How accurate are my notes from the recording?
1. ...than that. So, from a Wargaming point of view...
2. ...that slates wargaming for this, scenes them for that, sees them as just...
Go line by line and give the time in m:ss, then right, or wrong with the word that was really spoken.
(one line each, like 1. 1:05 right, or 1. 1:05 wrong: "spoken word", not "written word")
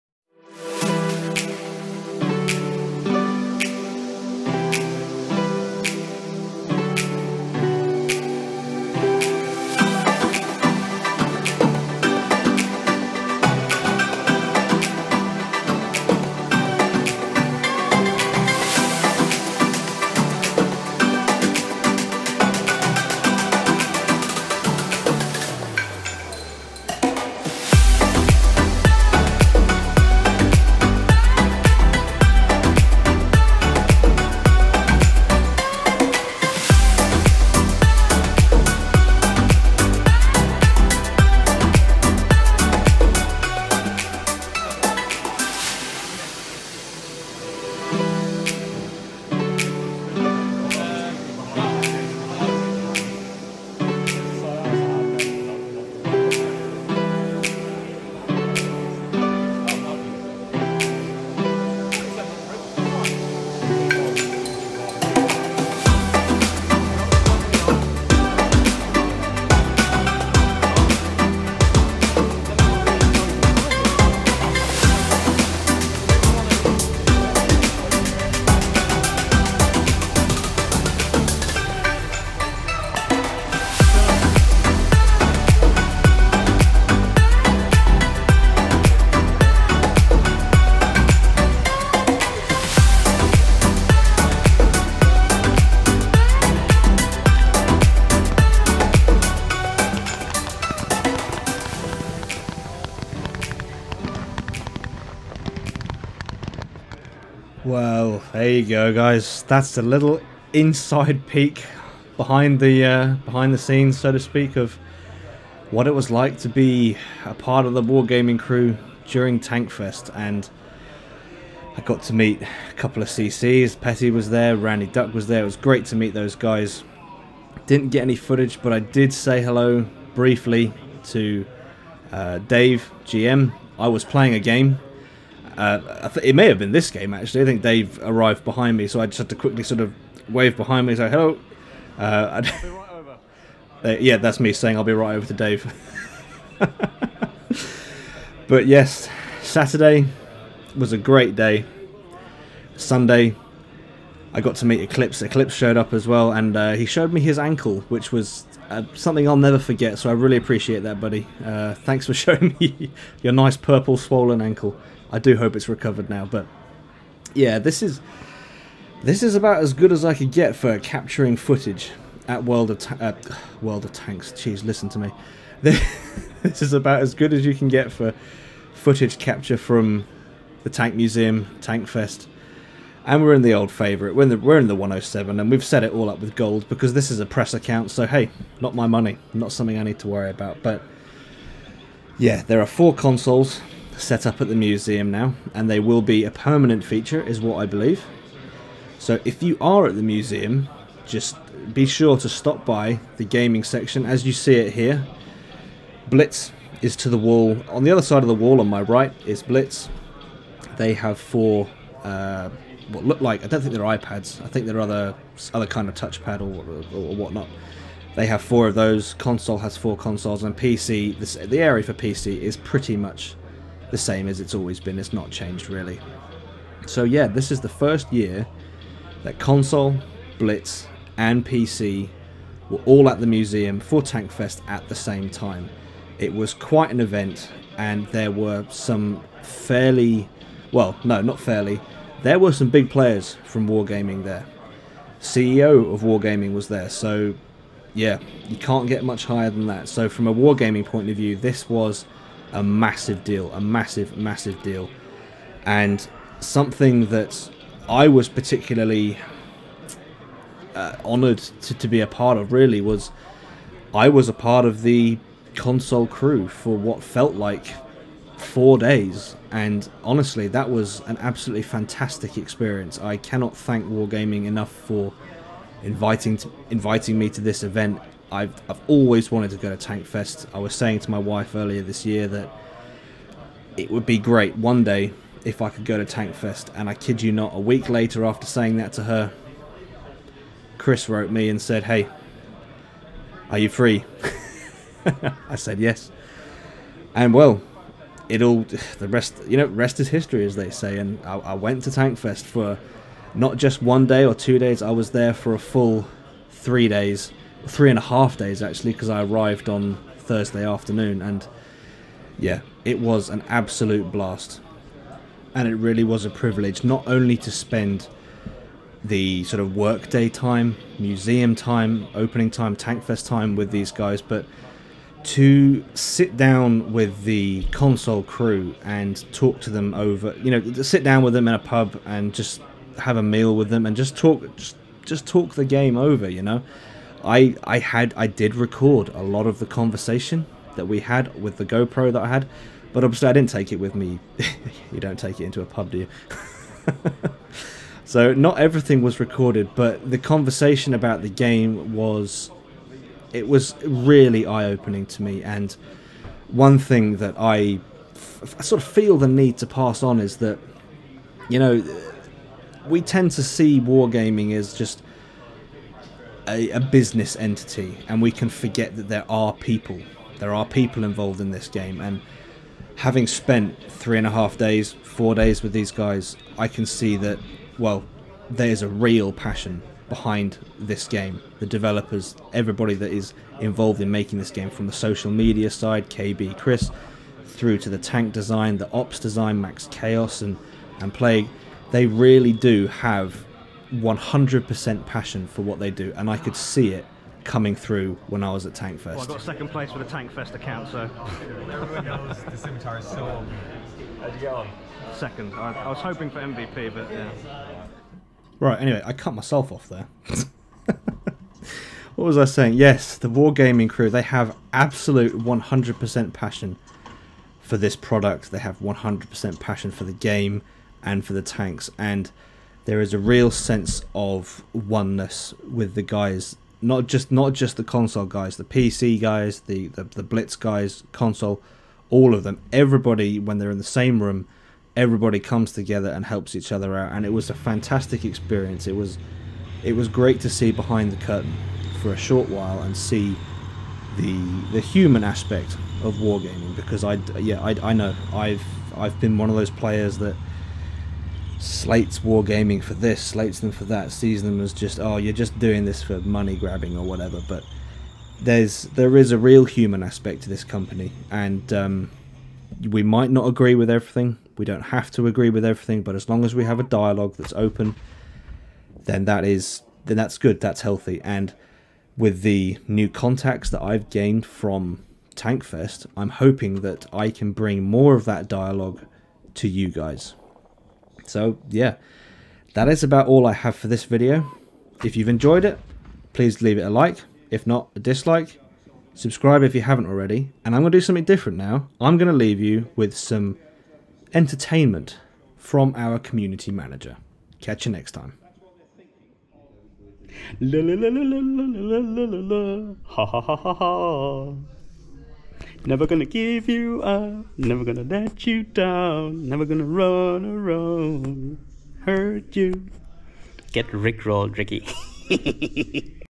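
1. 4:09 right
2. 7:30 wrong: "slates", not "scenes".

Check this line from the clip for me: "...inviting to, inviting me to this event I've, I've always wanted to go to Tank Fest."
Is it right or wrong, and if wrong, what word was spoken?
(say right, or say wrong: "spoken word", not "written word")
right.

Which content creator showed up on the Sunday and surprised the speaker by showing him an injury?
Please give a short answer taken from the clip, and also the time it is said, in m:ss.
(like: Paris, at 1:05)
Eclipse, at 2:32.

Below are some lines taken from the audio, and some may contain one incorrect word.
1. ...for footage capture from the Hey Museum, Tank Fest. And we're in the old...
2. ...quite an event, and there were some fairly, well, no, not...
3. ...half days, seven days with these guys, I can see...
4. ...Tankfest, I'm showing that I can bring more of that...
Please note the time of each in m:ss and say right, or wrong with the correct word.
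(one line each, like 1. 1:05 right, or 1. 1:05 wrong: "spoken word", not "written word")
1. 2:57 wrong: "Tank", not "Hey"
2. 3:56 right
3. 6:14 wrong: "four", not "seven"
4. 7:55 wrong: "hoping", not "showing".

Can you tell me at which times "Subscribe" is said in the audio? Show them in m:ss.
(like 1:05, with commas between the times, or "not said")
8:09.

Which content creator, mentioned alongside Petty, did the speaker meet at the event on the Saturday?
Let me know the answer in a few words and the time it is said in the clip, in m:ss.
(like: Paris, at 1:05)
Randy Duck, at 2:04.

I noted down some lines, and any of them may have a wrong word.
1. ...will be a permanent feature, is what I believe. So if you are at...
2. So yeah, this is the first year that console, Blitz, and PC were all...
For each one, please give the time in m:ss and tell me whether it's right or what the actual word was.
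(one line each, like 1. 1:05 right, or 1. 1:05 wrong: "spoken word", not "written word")
1. 3:15 right
2. 3:46 right.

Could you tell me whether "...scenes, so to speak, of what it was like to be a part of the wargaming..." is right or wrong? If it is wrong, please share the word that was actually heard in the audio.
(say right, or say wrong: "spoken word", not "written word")
right.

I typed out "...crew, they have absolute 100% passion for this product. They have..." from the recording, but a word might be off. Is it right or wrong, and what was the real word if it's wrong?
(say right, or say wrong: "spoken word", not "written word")
right.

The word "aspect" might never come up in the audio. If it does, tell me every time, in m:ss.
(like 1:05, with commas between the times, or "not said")
7:25, 7:40.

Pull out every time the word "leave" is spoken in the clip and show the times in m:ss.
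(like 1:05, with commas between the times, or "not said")
8:06, 8:12.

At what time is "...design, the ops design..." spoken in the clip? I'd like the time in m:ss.
6:28.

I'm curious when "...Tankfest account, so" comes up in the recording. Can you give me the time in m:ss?
6:40.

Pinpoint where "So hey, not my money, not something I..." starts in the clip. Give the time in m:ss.
3:07.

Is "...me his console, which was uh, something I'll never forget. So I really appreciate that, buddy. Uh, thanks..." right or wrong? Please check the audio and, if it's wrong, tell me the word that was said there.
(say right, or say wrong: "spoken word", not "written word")
wrong: "ankle", not "console".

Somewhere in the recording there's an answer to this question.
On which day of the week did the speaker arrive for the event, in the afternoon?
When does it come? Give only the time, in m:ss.
5:10.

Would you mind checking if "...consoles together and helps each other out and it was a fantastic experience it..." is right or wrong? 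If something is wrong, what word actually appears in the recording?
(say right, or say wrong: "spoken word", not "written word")
wrong: "comes", not "consoles".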